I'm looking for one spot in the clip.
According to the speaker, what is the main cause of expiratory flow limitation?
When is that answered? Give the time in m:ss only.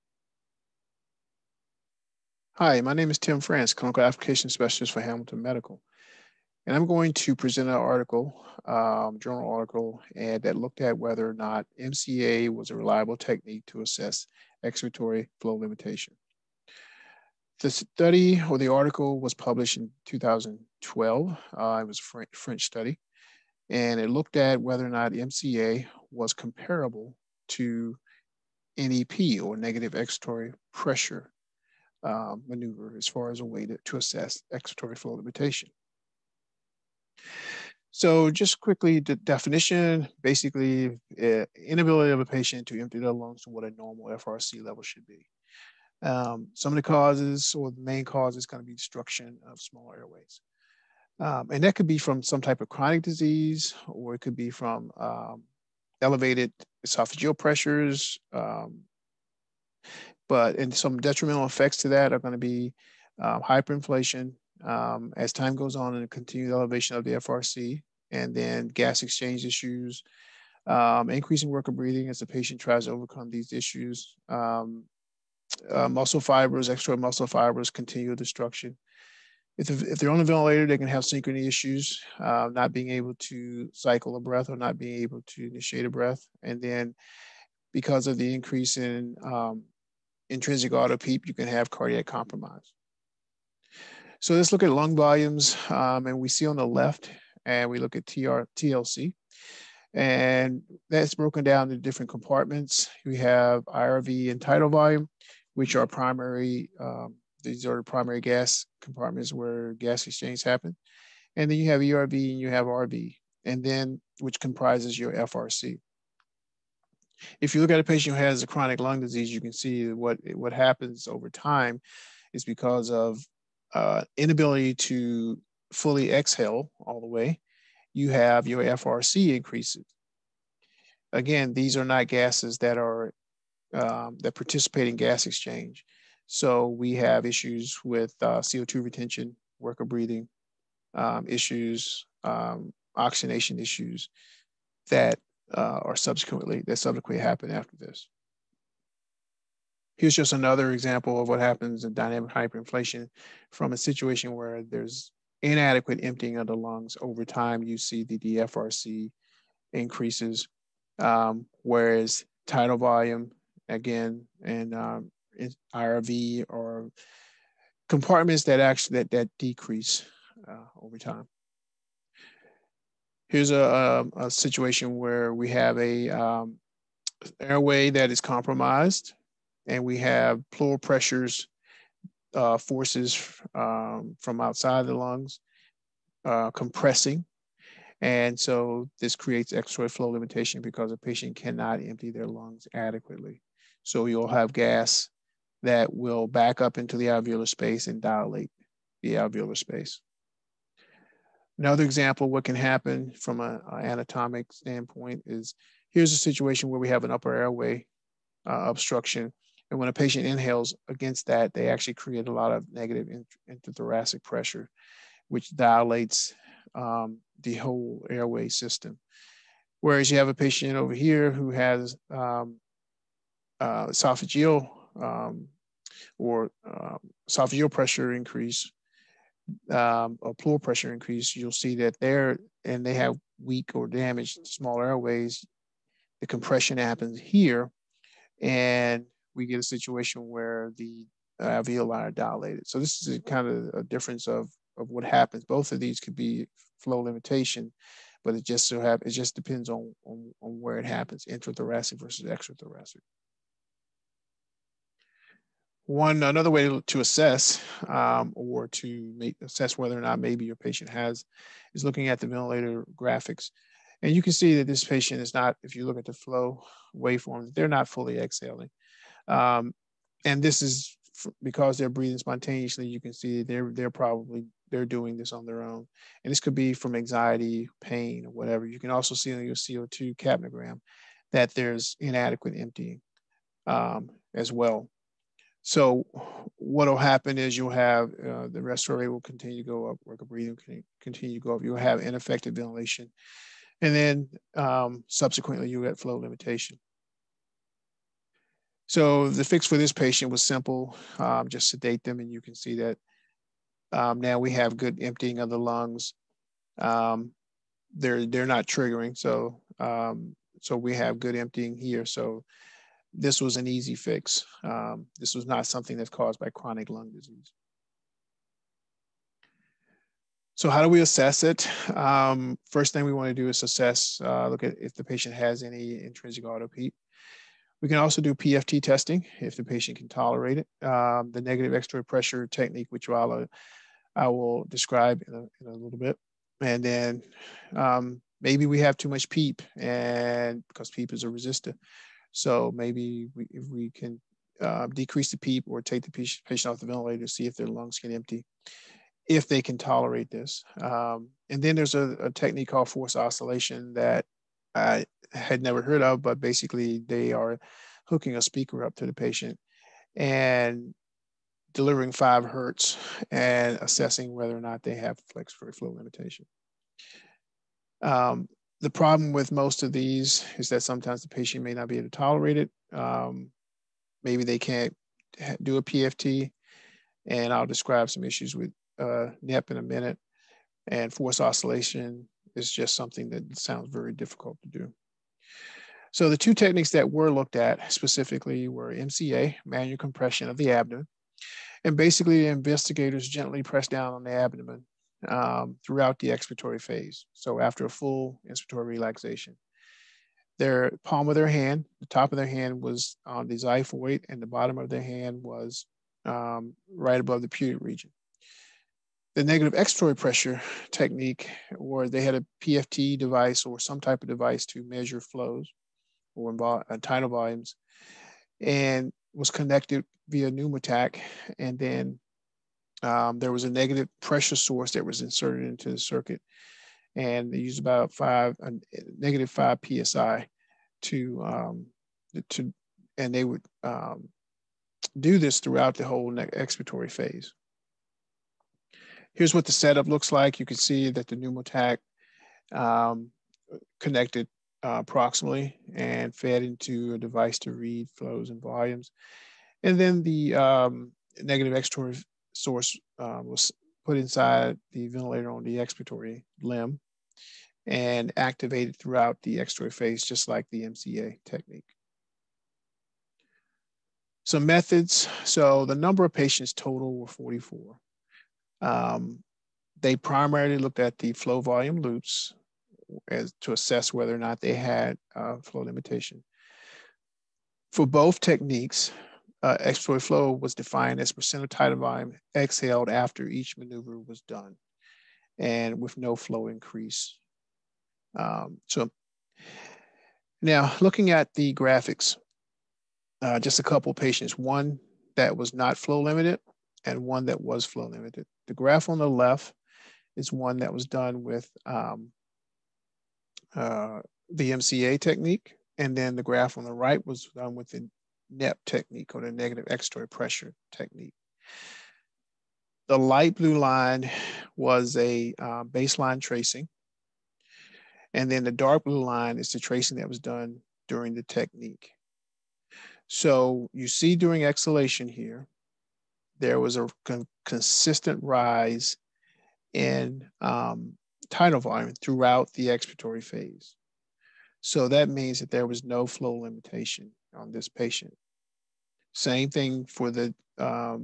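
0:48.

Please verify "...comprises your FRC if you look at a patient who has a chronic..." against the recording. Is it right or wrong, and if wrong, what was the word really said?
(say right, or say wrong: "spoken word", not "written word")
right.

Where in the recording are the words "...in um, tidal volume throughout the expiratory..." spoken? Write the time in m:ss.
8:49.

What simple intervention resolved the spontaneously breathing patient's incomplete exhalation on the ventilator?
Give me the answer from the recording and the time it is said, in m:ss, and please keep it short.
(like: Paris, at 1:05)
sedate them, at 5:01.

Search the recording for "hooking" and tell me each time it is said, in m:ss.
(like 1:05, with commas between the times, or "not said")
5:58.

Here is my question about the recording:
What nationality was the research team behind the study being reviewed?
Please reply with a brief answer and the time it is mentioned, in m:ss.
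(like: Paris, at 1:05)
French, at 0:22.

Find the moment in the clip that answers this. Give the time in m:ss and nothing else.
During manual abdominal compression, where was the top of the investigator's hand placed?
6:43.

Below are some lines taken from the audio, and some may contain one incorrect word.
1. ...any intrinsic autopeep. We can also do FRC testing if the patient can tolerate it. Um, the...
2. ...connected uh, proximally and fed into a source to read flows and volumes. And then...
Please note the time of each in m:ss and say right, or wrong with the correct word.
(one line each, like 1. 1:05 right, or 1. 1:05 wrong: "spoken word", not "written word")
1. 5:25 wrong: "PFT", not "FRC"
2. 7:23 wrong: "device", not "source".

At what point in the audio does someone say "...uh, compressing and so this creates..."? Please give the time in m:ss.
3:06.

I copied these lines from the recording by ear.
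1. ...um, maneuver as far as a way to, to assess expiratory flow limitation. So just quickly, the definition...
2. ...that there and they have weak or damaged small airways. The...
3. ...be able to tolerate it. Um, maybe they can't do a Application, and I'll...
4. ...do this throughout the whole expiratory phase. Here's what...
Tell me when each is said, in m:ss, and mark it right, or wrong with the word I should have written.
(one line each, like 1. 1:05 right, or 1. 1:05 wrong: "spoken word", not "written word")
1. 0:32 right
2. 3:51 right
3. 6:11 wrong: "PFT", not "Application"
4. 7:15 right.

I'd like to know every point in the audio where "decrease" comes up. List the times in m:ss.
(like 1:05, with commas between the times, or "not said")
2:49, 5:44.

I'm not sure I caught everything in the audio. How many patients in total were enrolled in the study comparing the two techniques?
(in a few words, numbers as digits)
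44.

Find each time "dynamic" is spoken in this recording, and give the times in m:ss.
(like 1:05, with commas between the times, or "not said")
2:31.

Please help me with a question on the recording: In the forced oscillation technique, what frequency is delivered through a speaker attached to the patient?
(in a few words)
5 hertz.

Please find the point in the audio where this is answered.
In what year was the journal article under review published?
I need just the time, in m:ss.
0:20.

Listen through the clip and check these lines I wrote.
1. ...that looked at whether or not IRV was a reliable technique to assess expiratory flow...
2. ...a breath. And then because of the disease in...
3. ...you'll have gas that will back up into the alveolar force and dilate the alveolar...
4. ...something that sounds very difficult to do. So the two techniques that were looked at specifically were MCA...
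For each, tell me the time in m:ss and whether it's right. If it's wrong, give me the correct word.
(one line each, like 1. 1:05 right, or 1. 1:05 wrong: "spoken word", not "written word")
1. 0:10 wrong: "MCA", not "IRV"
2. 1:25 wrong: "increase", not "disease"
3. 3:14 wrong: "space", not "force"
4. 6:22 right.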